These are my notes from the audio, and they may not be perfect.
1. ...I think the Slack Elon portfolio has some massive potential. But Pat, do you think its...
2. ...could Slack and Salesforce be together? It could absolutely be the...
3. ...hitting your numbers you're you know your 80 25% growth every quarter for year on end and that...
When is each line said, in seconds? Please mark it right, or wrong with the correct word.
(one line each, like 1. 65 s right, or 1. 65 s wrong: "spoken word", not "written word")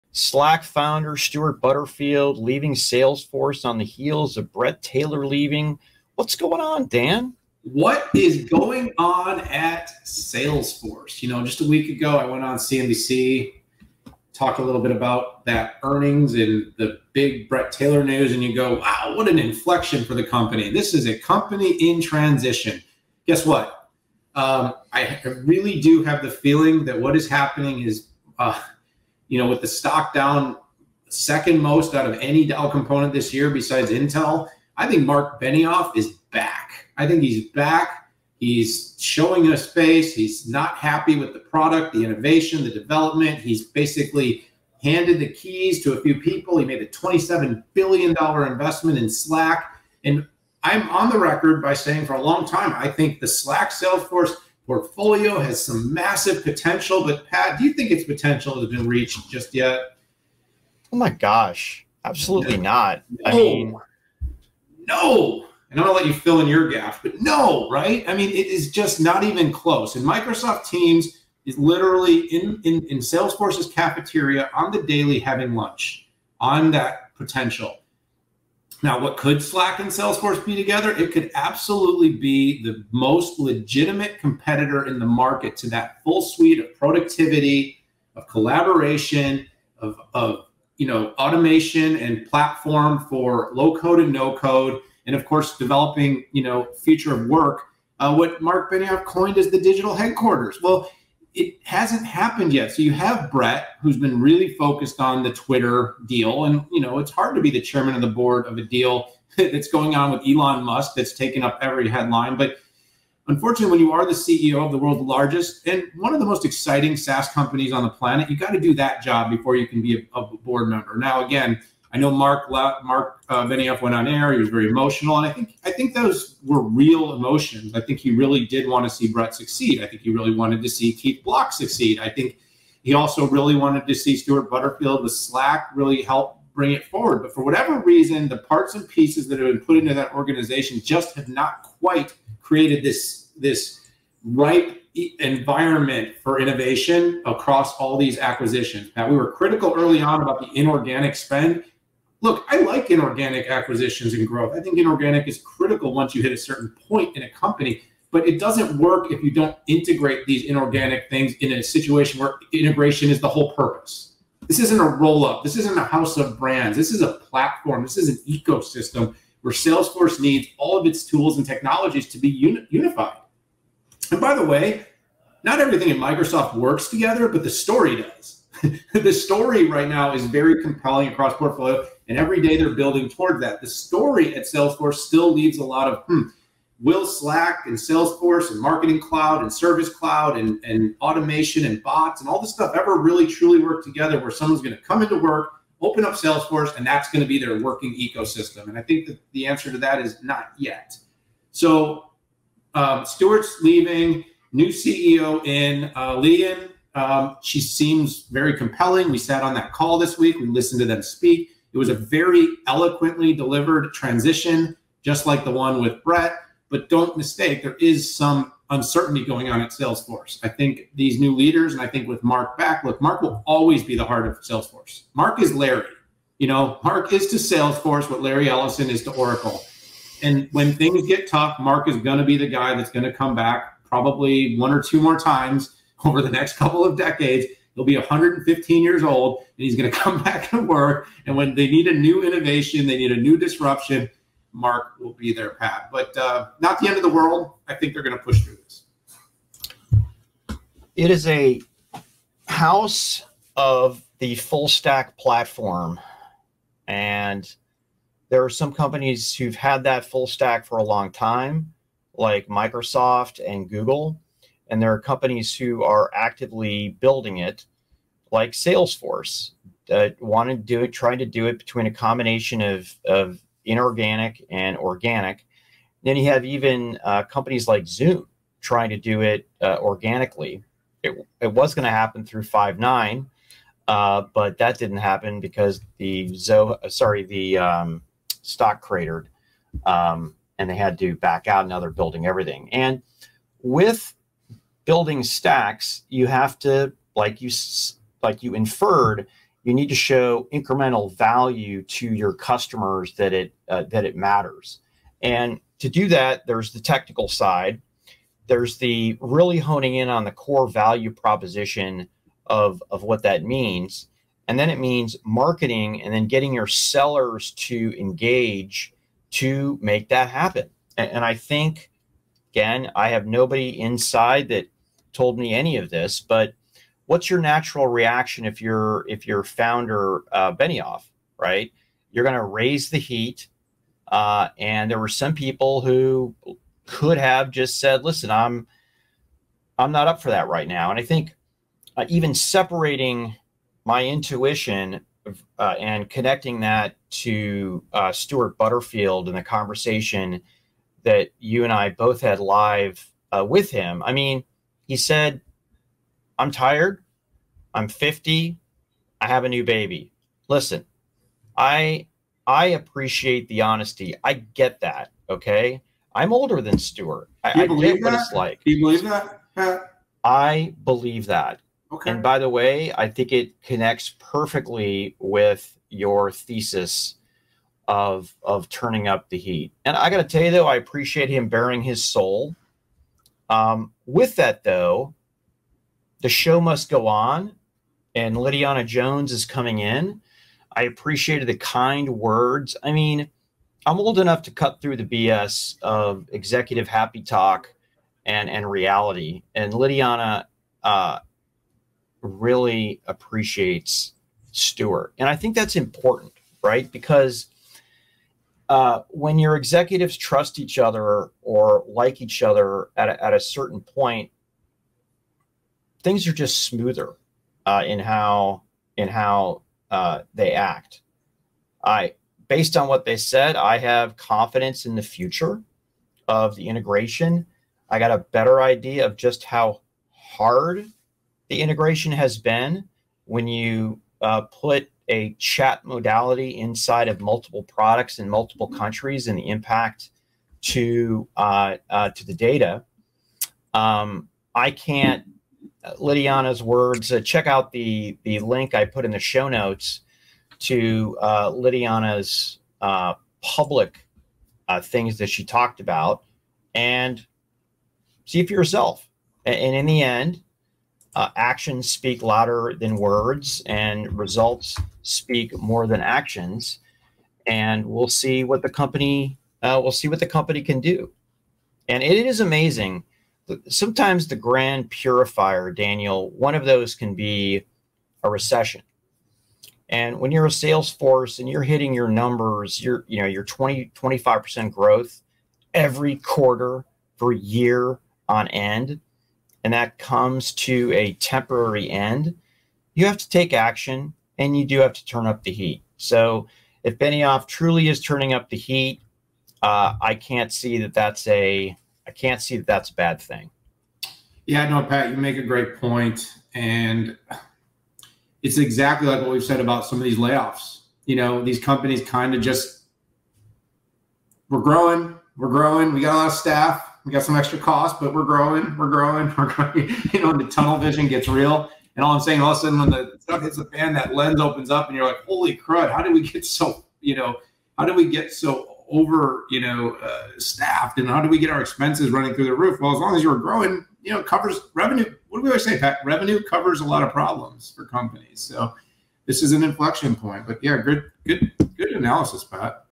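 1. 52 s wrong: "Salesforce", not "Elon"
2. 79 s right
3. 481 s wrong: "20", not "80".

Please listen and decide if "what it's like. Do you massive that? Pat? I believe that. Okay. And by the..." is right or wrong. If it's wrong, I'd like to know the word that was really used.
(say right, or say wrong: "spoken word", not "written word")
wrong: "believe", not "massive".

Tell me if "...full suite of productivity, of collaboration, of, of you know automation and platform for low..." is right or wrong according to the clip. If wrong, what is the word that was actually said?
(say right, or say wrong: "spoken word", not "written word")
right.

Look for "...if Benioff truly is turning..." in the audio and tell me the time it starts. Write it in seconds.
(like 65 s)
496 s.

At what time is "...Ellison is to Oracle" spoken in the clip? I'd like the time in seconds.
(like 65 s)
228 s.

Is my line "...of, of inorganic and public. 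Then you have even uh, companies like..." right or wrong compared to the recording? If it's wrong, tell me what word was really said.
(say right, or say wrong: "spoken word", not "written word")
wrong: "organic", not "public".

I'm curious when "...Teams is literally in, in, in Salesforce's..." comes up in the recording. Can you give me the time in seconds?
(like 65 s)
70 s.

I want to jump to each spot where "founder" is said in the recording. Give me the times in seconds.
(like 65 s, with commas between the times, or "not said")
0 s, 329 s.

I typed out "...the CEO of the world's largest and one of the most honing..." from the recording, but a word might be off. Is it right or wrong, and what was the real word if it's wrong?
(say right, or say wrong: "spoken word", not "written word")
wrong: "exciting", not "honing".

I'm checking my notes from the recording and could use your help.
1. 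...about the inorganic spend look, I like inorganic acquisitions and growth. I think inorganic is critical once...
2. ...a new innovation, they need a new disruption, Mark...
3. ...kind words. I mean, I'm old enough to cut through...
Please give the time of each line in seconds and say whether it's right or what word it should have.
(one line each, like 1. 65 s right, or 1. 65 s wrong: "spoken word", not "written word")
1. 150 s right
2. 241 s right
3. 391 s right.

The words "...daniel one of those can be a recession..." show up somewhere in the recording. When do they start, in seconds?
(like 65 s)
475 s.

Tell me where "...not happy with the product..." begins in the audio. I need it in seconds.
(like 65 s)
40 s.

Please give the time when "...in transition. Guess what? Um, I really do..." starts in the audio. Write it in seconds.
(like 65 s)
21 s.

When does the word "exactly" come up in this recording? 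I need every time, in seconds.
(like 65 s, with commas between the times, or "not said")
508 s.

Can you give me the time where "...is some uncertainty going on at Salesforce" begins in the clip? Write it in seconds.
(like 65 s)
217 s.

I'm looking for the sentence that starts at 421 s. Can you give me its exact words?
I, based on what they said, I have confidence in the future of the integration.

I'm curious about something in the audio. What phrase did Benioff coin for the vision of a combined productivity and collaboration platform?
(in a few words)
digital headquarters.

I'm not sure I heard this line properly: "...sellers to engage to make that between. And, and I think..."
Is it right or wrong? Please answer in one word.
wrong.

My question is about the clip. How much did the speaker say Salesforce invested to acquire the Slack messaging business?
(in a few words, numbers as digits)
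$27 billion.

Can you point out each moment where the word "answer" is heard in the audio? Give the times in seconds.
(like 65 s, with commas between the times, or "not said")
199 s.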